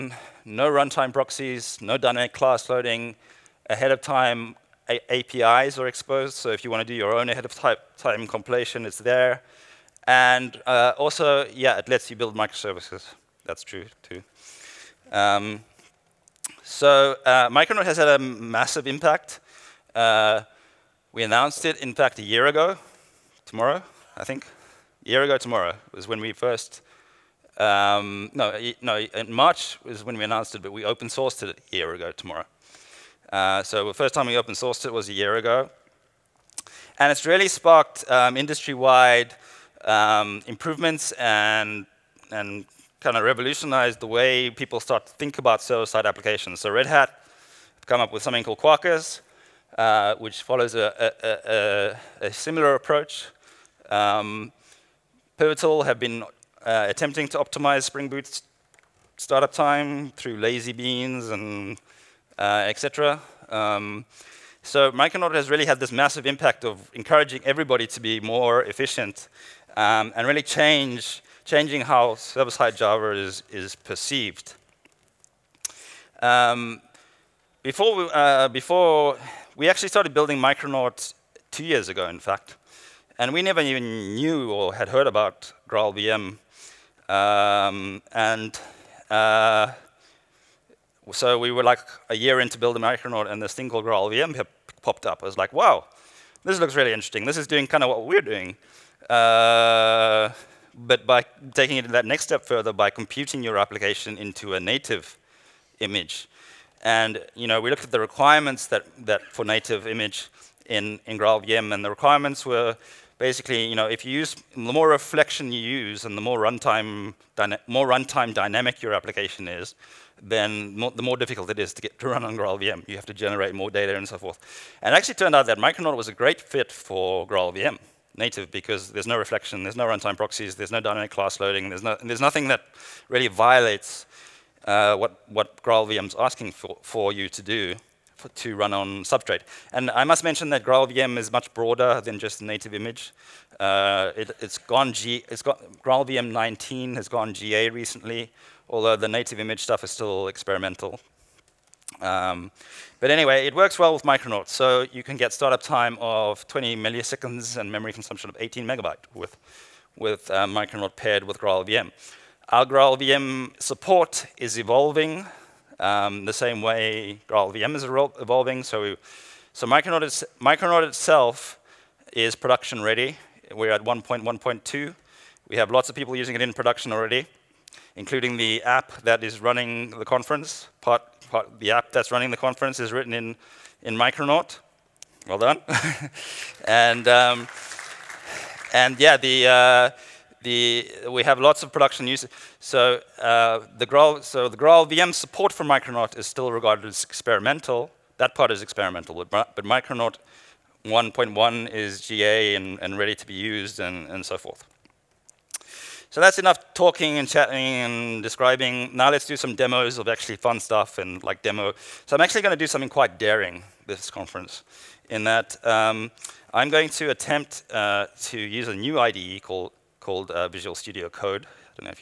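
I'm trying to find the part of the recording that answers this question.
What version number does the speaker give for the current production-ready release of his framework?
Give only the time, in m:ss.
2:53.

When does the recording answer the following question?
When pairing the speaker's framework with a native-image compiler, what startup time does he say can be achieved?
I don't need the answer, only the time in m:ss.
2:36.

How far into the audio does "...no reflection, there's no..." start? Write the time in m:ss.
2:09.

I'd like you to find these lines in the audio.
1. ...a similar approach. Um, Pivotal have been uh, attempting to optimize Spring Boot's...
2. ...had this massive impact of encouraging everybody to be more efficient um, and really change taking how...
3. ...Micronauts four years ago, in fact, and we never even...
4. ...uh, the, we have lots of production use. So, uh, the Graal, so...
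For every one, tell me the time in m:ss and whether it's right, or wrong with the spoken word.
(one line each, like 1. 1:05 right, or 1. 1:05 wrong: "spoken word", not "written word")
1. 0:52 right
2. 1:05 wrong: "changing", not "taking"
3. 1:20 wrong: "two", not "four"
4. 3:09 right.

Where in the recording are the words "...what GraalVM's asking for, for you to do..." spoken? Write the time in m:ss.
2:15.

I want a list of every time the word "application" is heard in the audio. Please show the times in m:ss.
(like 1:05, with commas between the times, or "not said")
0:46, 1:43, 1:58.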